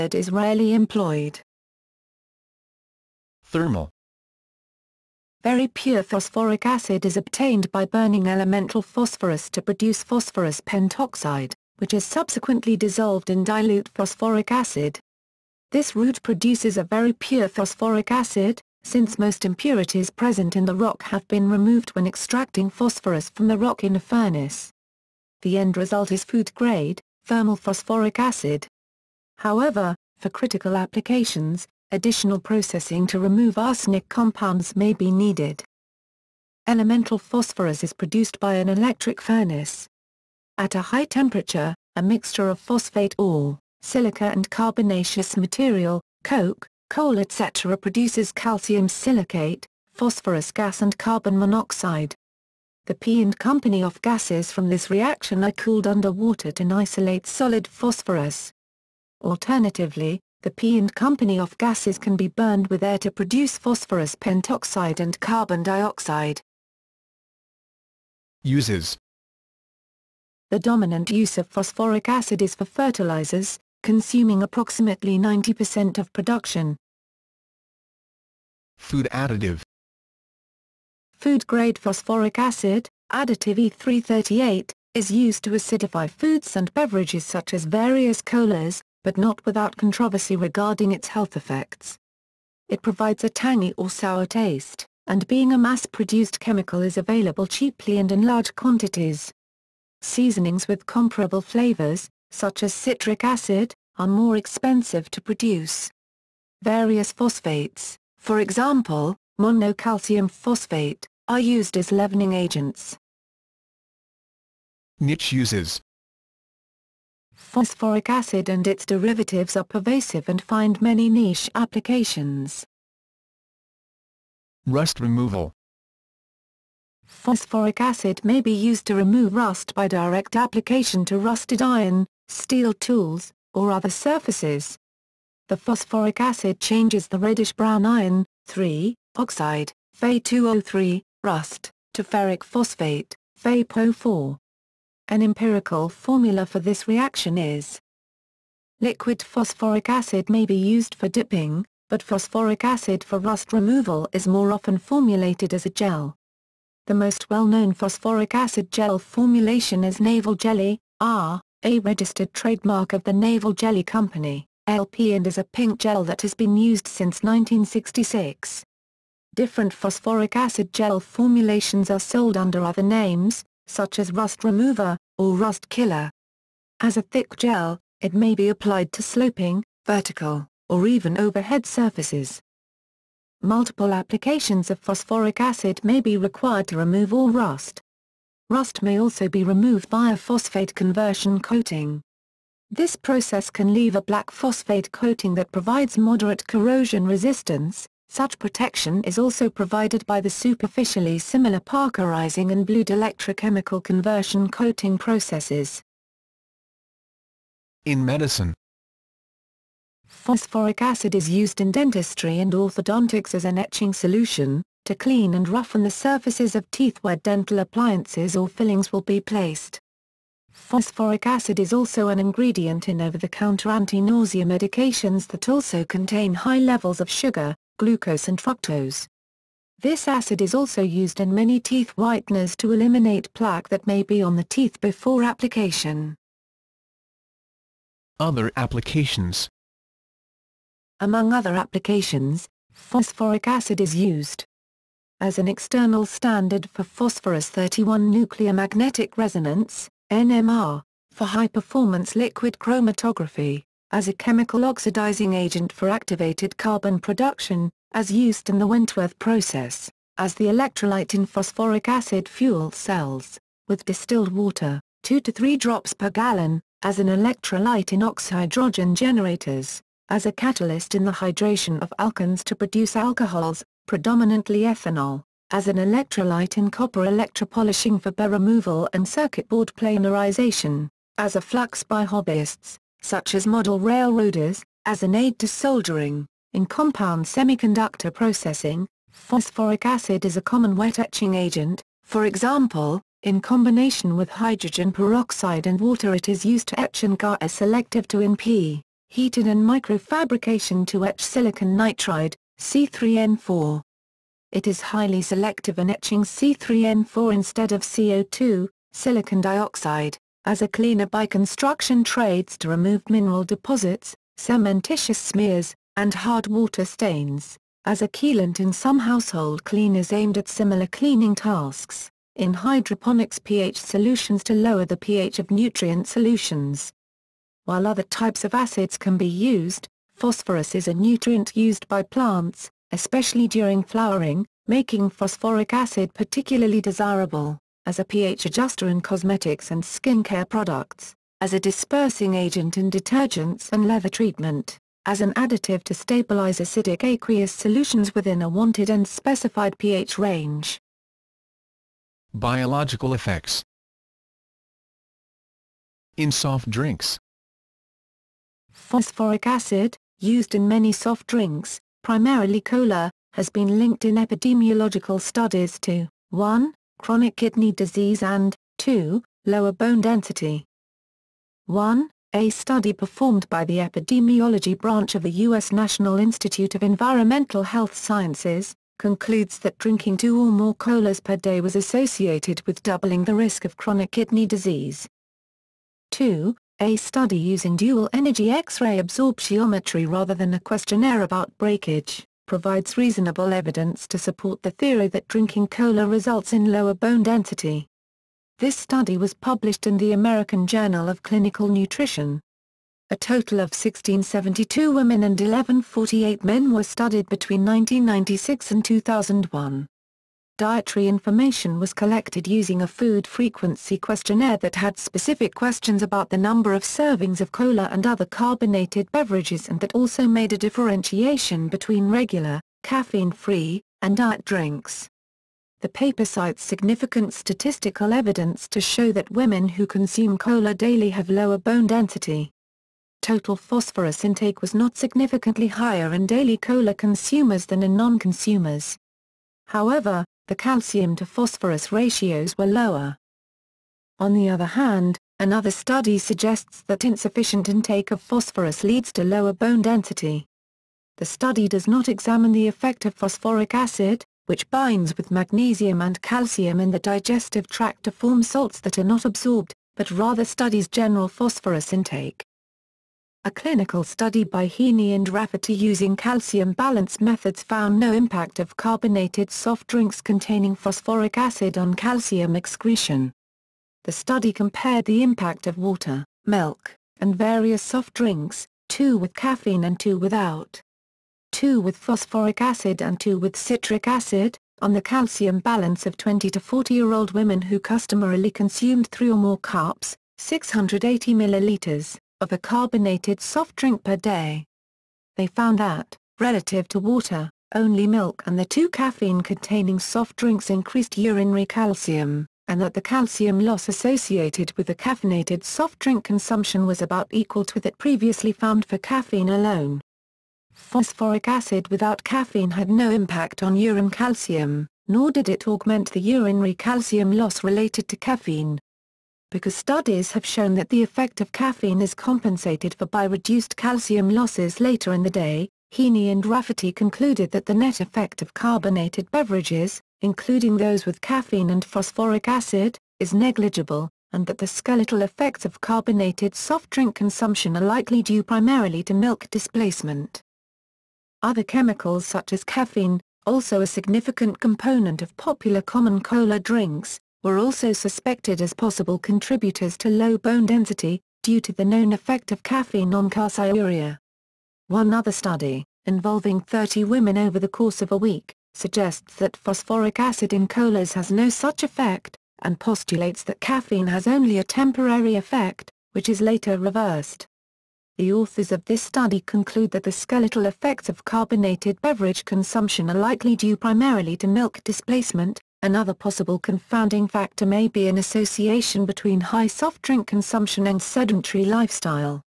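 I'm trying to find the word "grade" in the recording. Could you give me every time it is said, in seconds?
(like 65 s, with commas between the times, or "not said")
26 s, 81 s.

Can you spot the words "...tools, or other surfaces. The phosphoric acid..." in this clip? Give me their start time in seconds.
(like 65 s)
132 s.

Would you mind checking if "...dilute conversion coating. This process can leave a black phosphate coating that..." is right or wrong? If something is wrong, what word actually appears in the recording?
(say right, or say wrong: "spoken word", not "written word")
wrong: "phosphate", not "dilute".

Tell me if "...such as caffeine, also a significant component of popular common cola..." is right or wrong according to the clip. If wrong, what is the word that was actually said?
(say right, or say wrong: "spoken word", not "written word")
right.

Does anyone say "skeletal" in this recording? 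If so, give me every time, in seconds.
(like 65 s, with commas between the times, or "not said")
534 s, 570 s.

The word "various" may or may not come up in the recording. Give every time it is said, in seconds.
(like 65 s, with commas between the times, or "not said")
87 s, 106 s, 477 s.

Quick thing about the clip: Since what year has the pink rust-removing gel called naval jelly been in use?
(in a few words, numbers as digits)
1966.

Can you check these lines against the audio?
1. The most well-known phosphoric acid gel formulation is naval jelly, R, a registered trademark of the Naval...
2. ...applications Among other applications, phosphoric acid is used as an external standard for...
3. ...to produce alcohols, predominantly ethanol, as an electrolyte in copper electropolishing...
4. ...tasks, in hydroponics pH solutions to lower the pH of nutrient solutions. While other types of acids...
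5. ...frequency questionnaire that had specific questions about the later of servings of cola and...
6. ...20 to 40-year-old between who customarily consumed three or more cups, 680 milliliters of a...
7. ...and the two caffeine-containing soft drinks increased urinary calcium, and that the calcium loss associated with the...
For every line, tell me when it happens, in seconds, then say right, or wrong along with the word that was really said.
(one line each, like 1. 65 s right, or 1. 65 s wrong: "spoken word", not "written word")
1. 156 s right
2. 238 s right
3. 272 s right
4. 321 s right
5. 413 s wrong: "number", not "later"
6. 486 s wrong: "women", not "between"
7. 498 s right.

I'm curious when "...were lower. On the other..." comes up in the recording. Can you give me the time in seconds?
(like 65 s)
442 s.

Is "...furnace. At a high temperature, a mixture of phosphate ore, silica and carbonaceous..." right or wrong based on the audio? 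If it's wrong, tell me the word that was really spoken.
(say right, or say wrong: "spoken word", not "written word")
right.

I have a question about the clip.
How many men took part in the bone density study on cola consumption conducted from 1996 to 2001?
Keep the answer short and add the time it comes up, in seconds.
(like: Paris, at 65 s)
1148, at 405 s.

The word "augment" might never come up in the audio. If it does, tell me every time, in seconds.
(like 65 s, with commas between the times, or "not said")
515 s.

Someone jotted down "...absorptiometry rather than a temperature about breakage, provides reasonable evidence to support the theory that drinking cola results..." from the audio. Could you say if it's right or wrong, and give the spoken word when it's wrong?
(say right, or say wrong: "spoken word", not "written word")
wrong: "questionnaire", not "temperature".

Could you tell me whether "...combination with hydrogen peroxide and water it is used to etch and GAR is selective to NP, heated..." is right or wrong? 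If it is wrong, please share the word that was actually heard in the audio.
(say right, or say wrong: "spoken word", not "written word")
right.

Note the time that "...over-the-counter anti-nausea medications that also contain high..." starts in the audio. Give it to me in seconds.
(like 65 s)
222 s.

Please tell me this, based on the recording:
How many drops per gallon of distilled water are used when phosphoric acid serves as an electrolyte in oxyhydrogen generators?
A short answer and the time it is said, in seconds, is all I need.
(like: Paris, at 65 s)
2 to 3, at 265 s.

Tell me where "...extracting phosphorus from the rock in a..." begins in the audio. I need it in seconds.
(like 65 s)
22 s.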